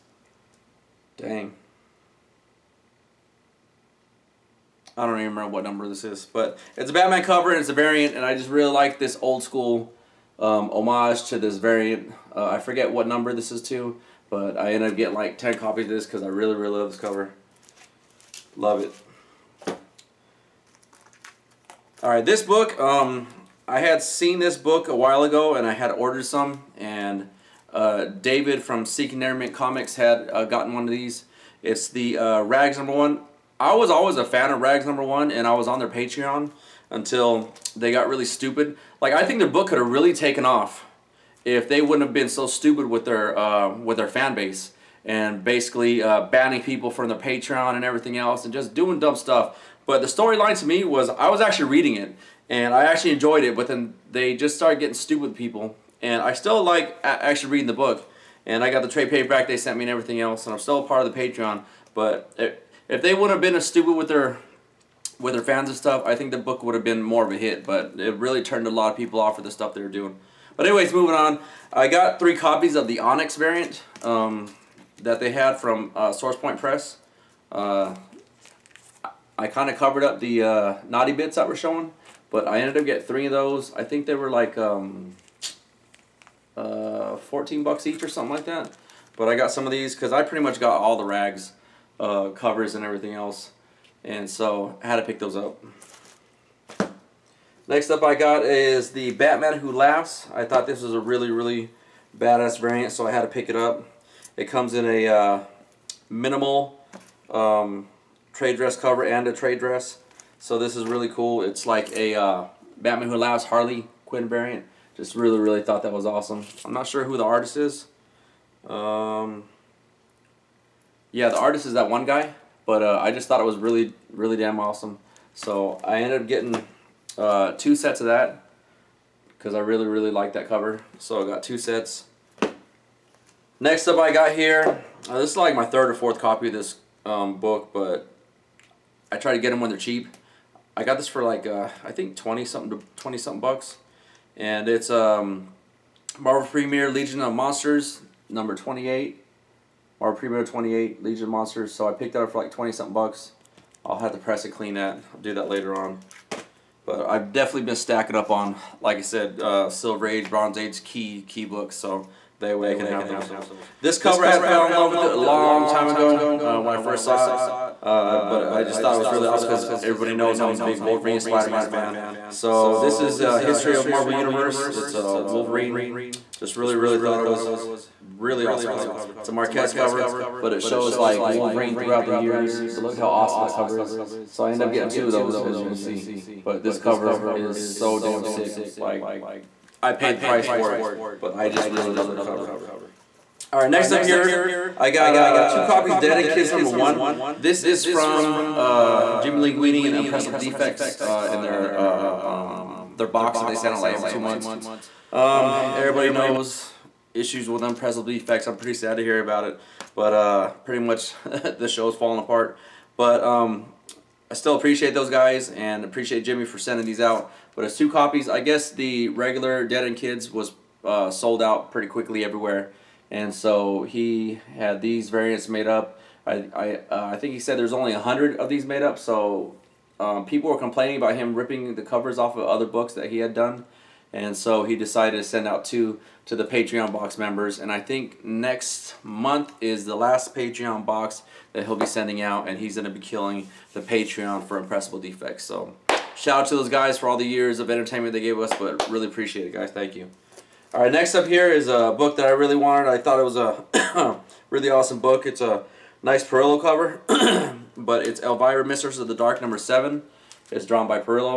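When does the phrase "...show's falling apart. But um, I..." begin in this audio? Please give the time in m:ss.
3:31.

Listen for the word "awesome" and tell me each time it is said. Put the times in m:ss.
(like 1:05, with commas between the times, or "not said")
1:56, 2:04, 2:49, 2:58, 3:03, 4:14.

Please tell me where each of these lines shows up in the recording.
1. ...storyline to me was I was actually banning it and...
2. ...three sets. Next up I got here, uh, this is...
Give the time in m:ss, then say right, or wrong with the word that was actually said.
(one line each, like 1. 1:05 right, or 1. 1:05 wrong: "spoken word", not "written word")
1. 0:50 wrong: "reading", not "banning"
2. 2:11 wrong: "two", not "three".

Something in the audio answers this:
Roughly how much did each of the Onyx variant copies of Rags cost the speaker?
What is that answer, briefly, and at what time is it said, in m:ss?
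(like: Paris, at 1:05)
$14, at 1:27.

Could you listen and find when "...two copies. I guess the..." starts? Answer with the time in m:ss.
3:37.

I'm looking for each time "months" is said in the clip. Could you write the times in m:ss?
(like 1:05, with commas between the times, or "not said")
3:24, 3:59.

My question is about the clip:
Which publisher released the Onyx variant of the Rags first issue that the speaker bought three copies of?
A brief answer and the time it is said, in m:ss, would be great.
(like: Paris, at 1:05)
Source Point Press, at 1:16.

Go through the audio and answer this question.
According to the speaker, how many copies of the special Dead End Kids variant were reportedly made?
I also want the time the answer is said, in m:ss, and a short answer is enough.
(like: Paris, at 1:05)
100, at 3:47.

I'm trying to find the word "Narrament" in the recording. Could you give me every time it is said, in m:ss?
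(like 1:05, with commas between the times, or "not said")
0:29.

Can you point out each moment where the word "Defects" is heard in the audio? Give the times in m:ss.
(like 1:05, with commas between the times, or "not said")
3:20, 3:28, 4:05.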